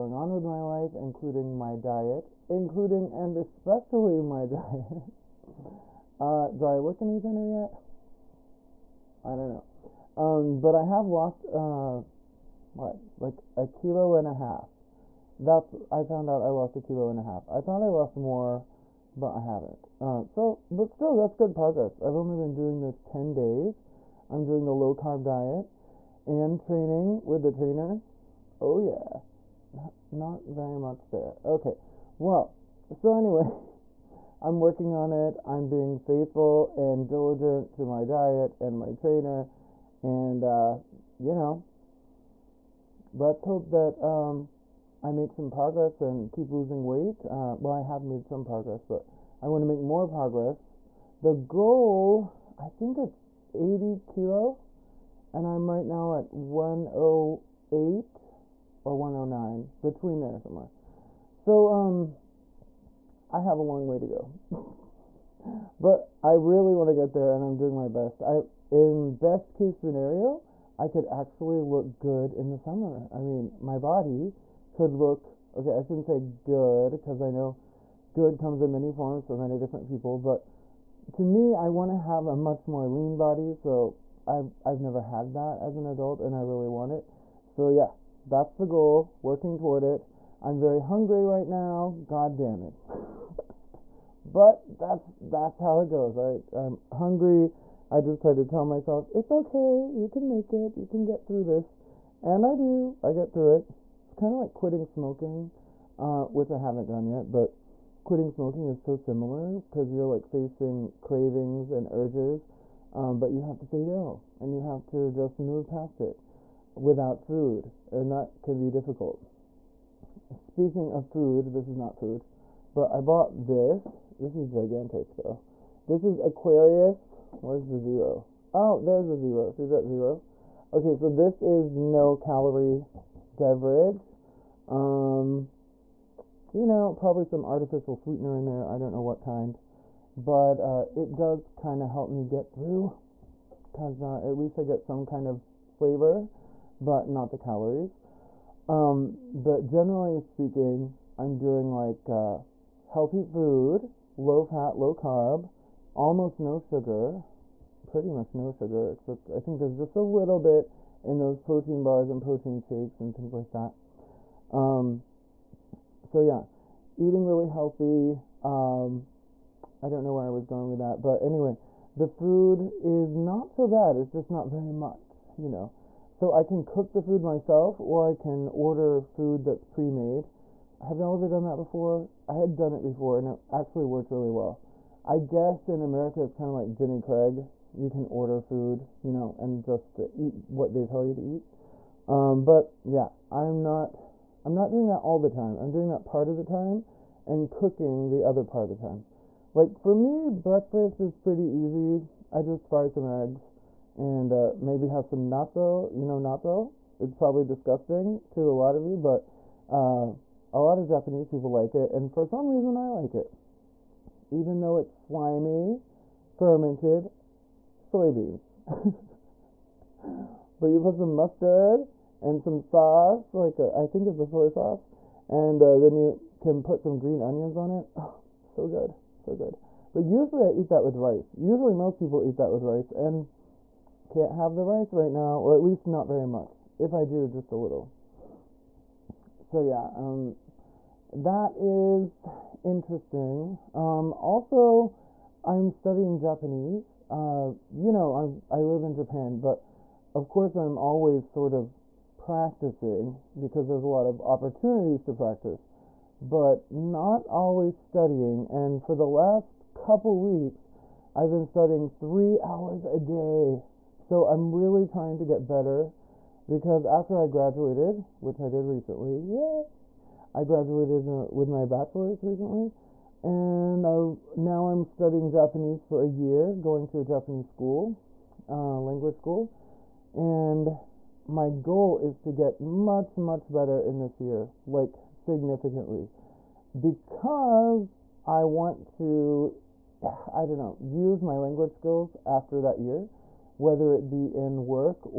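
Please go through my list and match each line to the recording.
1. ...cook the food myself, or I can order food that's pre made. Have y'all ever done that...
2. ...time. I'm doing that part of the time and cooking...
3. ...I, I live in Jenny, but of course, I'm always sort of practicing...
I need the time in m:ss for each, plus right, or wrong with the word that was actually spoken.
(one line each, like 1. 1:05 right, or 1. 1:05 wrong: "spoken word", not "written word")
1. 2:56 right
2. 3:15 right
3. 4:08 wrong: "Japan", not "Jenny".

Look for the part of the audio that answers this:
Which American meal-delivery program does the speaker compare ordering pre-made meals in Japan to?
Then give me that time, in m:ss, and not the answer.
3:06.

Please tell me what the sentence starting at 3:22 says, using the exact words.
I just fry some eggs and uh, maybe have some natto.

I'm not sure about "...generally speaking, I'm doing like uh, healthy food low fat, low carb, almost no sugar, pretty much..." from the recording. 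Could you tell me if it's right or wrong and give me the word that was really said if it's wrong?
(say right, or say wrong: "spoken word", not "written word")
right.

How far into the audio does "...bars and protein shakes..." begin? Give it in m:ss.
2:41.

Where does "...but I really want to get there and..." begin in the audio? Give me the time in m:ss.
1:05.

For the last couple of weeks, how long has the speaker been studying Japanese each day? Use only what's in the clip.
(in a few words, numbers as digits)
3 hours.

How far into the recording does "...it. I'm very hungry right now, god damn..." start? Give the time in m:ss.
1:29.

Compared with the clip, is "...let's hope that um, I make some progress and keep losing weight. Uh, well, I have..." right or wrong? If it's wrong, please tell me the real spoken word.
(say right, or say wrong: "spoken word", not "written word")
right.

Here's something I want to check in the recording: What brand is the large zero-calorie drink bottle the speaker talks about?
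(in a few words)
Aquarius.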